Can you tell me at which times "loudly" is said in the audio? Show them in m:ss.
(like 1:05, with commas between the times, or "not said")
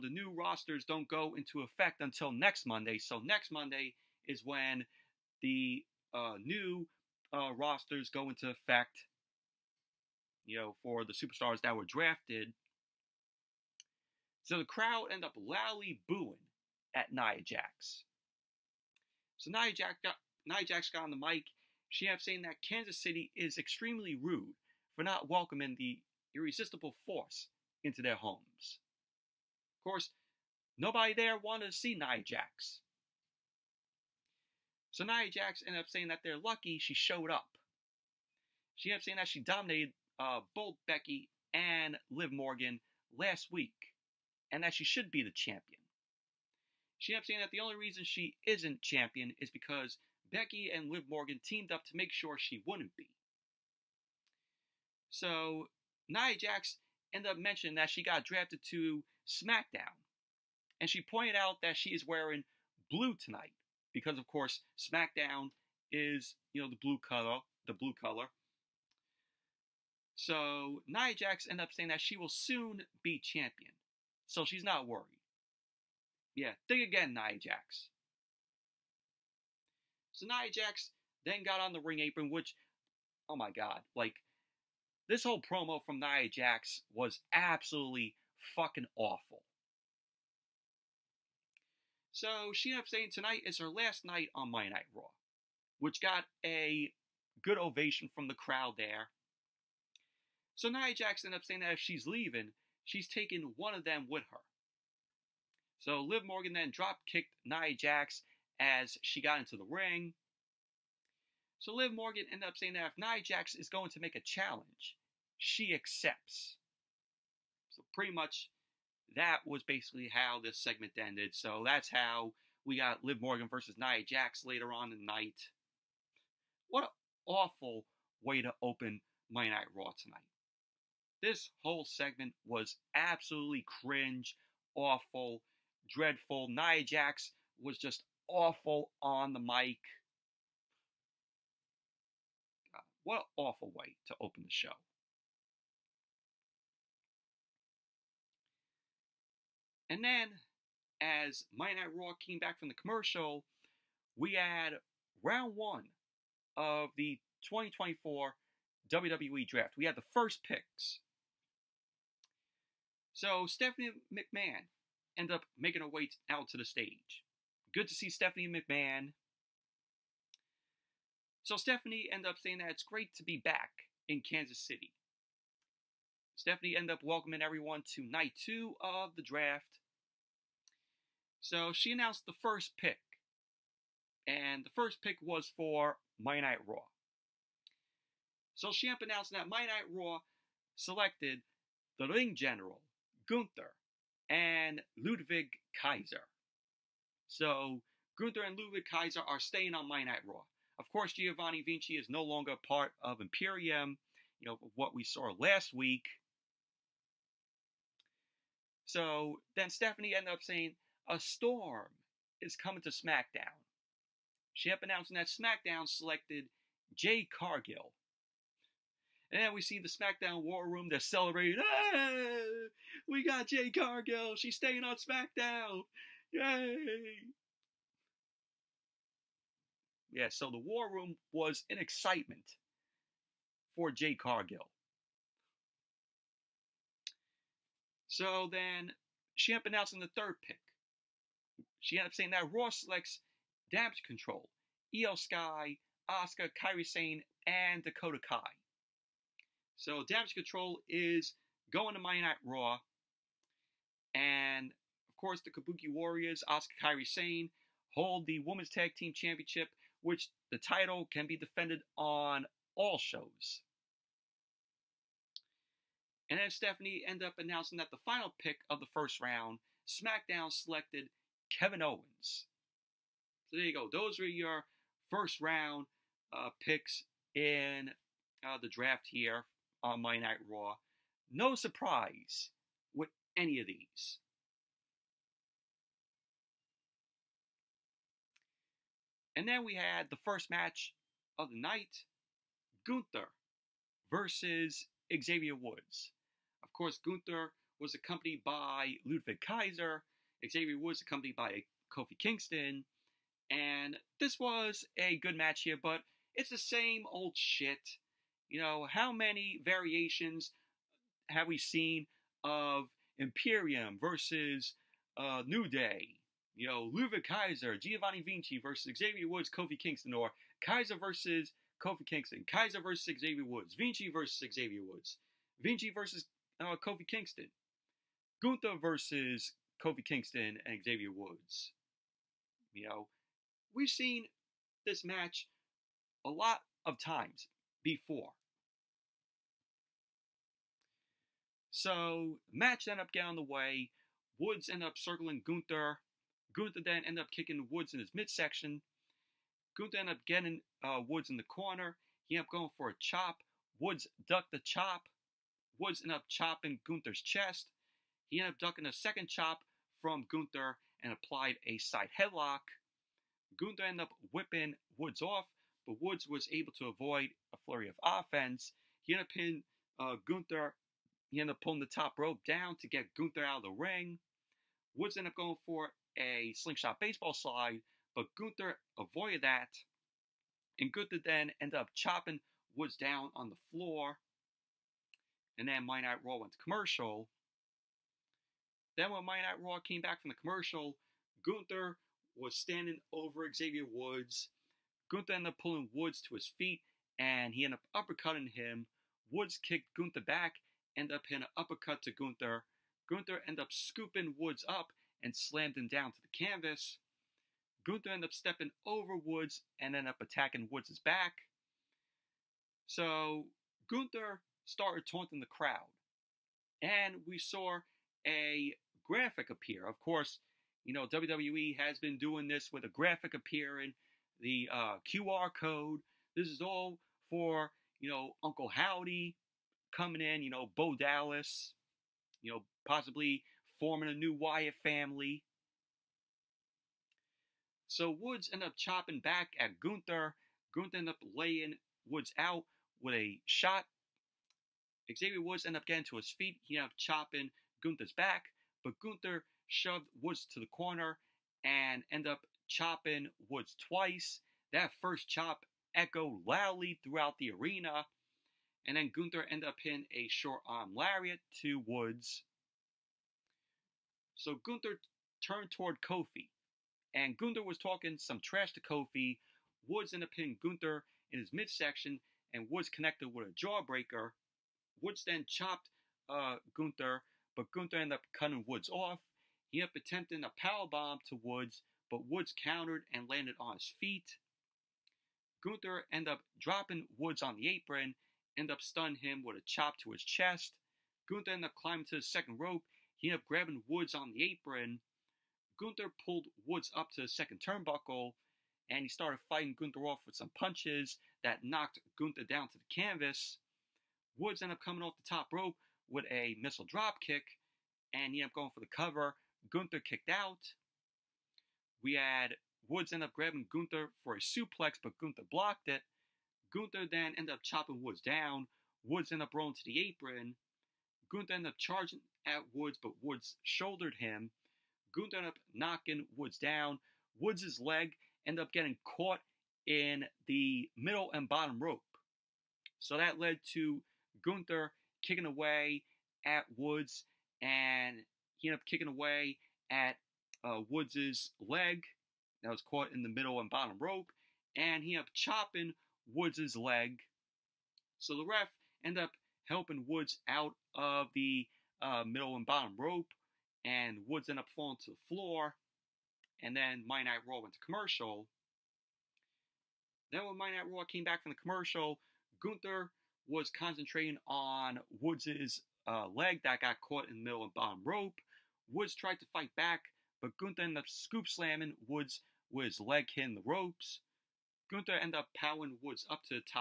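0:15, 7:36.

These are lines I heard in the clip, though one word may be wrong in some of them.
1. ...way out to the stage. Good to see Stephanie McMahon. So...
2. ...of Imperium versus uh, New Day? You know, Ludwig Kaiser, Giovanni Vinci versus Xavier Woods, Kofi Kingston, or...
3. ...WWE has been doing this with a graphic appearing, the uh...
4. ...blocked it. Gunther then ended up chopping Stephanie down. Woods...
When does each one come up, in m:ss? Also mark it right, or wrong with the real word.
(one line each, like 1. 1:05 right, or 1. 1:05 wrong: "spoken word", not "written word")
1. 2:45 right
2. 5:12 right
3. 7:01 right
4. 8:35 wrong: "Woods", not "Stephanie".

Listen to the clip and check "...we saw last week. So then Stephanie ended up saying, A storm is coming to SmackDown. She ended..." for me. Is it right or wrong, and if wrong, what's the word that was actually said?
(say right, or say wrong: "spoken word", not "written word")
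right.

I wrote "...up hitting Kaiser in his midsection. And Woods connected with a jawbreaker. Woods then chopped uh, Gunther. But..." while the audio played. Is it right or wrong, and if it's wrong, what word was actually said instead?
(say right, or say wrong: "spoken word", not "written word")
wrong: "Gunther", not "Kaiser".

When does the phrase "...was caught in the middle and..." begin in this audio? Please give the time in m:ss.
9:02.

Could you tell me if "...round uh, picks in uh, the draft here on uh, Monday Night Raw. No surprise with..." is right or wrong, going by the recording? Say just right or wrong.
right.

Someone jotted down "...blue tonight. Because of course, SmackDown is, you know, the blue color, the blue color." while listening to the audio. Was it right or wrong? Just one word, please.
right.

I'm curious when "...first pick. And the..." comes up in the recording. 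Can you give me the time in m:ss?
3:02.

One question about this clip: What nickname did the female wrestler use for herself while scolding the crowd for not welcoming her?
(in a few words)
the irresistible force.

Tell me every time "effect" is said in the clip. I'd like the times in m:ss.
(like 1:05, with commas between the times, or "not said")
0:01, 0:08.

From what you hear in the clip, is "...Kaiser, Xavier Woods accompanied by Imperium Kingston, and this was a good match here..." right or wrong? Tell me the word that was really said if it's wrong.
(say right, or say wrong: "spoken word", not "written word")
wrong: "Kofi", not "Imperium".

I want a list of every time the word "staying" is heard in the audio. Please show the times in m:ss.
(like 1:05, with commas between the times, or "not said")
3:19, 3:44.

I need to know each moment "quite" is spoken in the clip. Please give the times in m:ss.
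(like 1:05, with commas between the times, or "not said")
not said.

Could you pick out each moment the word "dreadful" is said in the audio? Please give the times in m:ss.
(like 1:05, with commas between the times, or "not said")
2:15.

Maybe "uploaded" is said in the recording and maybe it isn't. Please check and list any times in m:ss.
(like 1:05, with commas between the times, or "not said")
not said.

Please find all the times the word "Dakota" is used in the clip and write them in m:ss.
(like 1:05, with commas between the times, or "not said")
4:07.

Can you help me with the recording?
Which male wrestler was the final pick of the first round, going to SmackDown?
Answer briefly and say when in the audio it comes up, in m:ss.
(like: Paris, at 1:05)
Kevin Owens, at 4:31.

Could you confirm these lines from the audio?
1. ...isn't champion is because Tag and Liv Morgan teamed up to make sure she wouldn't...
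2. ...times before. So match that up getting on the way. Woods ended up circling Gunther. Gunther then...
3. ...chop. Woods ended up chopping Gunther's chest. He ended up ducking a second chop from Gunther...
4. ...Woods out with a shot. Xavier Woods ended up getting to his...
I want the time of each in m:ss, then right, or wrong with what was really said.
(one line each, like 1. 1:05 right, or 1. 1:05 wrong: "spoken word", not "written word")
1. 0:48 wrong: "Becky", not "Tag"
2. 5:36 right
3. 5:54 right
4. 7:22 right.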